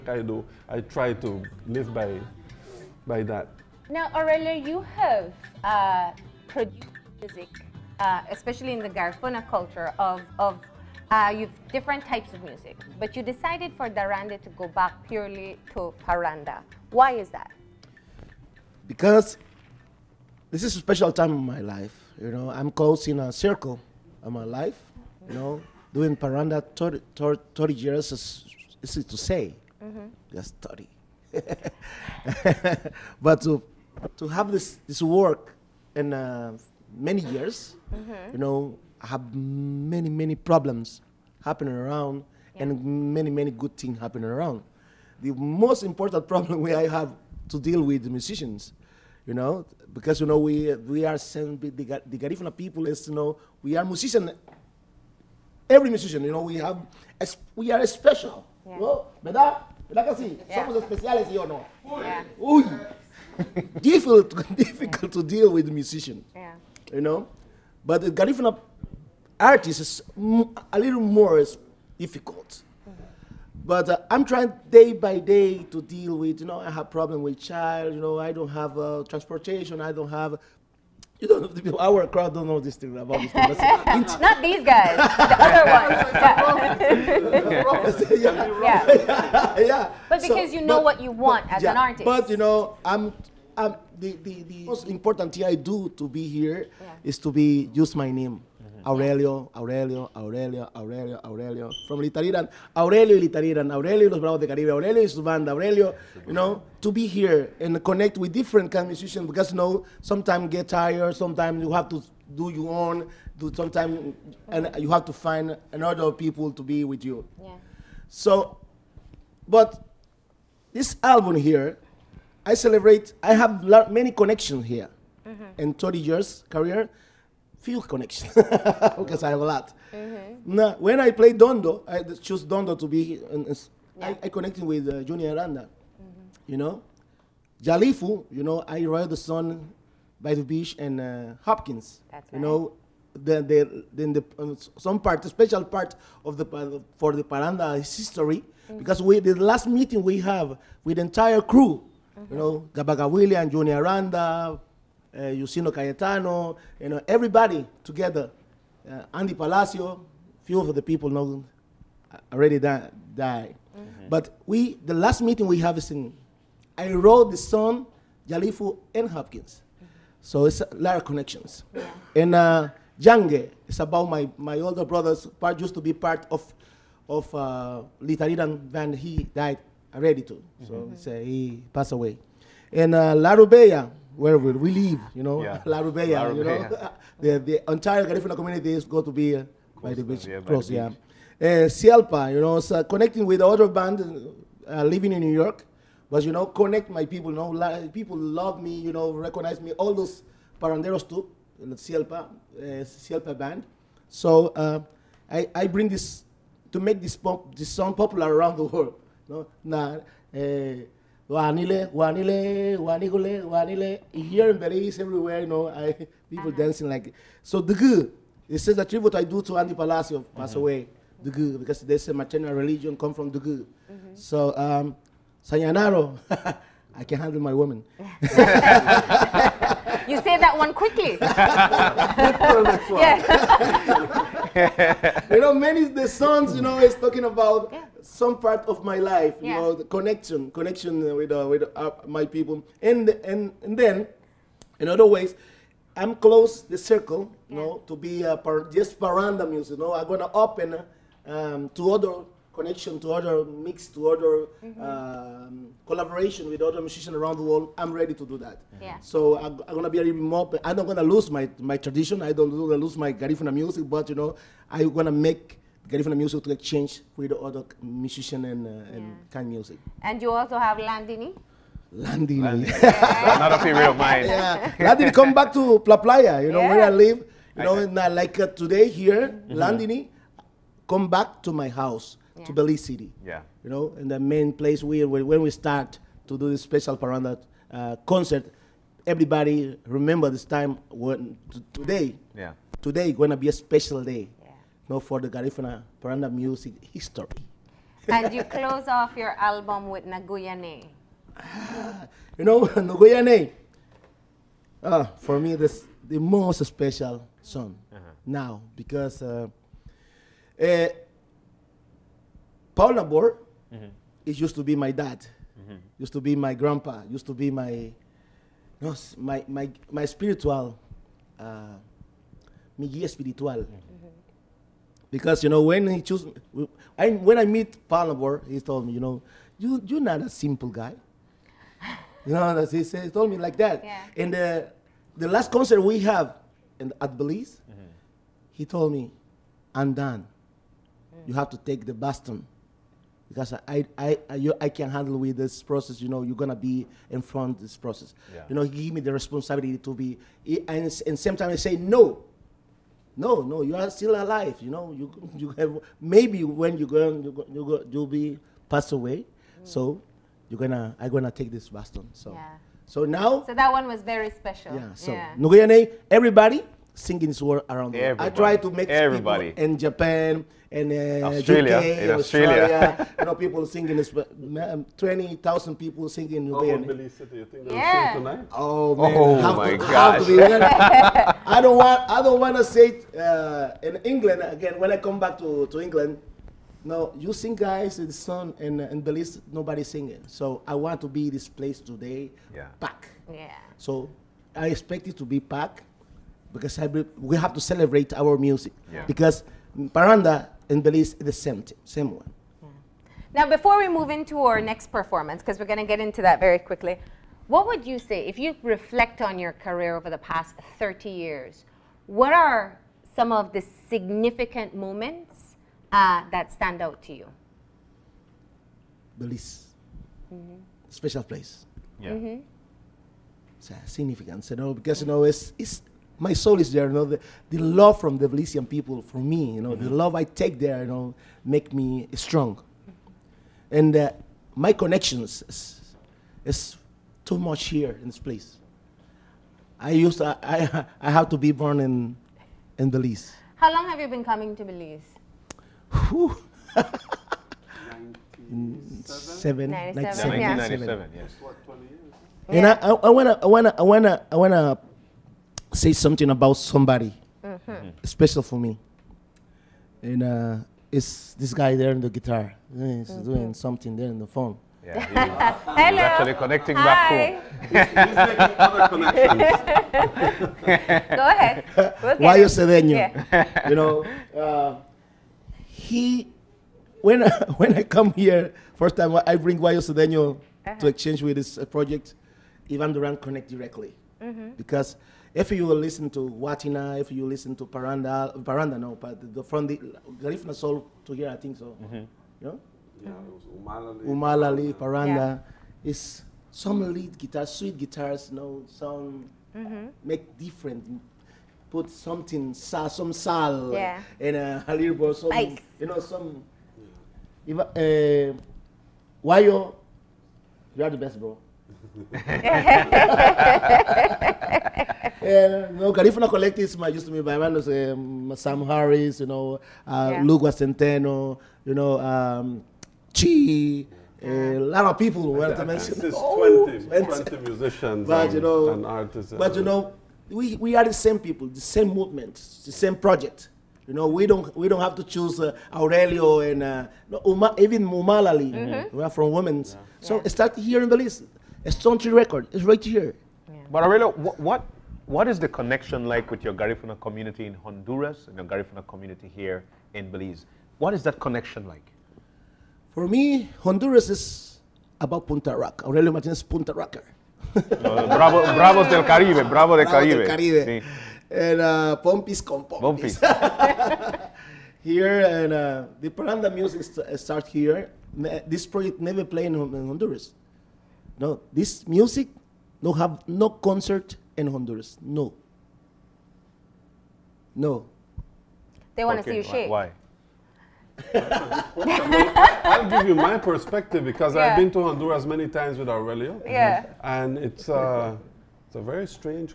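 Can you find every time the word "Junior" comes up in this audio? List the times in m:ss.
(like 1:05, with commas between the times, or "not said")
2:15, 2:33.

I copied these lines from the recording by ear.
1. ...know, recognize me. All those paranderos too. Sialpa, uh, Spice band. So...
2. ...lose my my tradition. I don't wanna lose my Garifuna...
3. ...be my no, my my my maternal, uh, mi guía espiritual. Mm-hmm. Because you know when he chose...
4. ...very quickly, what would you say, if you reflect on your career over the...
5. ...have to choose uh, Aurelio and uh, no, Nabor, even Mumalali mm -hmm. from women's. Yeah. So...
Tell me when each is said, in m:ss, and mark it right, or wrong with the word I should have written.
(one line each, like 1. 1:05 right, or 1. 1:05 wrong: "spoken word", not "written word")
1. 3:18 wrong: "Sialpa", not "Spice"
2. 4:21 right
3. 5:17 wrong: "spiritual", not "maternal"
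4. 6:46 right
5. 8:54 wrong: "Uma", not "Nabor".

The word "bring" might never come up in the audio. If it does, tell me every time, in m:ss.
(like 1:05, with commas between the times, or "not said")
3:25, 7:59.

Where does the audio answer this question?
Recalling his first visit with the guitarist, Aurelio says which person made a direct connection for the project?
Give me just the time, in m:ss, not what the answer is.
8:02.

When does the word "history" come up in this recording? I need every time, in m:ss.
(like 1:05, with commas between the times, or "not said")
2:27, 4:56.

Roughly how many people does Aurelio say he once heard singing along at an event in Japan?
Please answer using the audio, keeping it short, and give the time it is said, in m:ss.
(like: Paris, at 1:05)
20,000, at 6:14.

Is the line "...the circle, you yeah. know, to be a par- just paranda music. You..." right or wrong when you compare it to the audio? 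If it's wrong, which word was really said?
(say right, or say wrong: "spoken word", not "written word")
right.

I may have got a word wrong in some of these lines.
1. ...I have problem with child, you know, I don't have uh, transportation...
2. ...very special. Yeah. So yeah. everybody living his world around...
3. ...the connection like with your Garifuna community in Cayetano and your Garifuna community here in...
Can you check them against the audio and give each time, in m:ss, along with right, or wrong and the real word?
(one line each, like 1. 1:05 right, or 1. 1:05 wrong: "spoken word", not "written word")
1. 1:16 right
2. 6:04 wrong: "singing", not "living"
3. 9:05 wrong: "Honduras", not "Cayetano".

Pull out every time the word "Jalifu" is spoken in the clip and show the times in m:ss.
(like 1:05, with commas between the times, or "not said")
2:17, 2:48.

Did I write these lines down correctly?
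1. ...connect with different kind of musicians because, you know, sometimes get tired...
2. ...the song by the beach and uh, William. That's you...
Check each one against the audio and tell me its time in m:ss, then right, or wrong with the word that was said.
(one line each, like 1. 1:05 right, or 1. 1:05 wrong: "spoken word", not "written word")
1. 1:47 right
2. 2:19 wrong: "Hopkins", not "William".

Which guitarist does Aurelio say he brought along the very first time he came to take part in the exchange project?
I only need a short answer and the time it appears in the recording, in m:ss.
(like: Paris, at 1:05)
Guayo Cedeño, at 7:59.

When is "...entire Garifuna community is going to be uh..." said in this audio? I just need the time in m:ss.
3:07.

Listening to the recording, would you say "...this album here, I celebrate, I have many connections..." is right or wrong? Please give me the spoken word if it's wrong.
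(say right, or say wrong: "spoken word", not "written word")
right.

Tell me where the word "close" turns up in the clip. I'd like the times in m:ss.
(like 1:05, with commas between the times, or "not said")
0:22, 3:10, 4:06, 4:58.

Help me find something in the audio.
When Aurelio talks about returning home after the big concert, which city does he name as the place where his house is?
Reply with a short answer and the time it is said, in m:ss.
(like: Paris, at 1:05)
Belize City, at 4:42.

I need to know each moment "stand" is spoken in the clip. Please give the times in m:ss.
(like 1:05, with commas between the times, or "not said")
6:56.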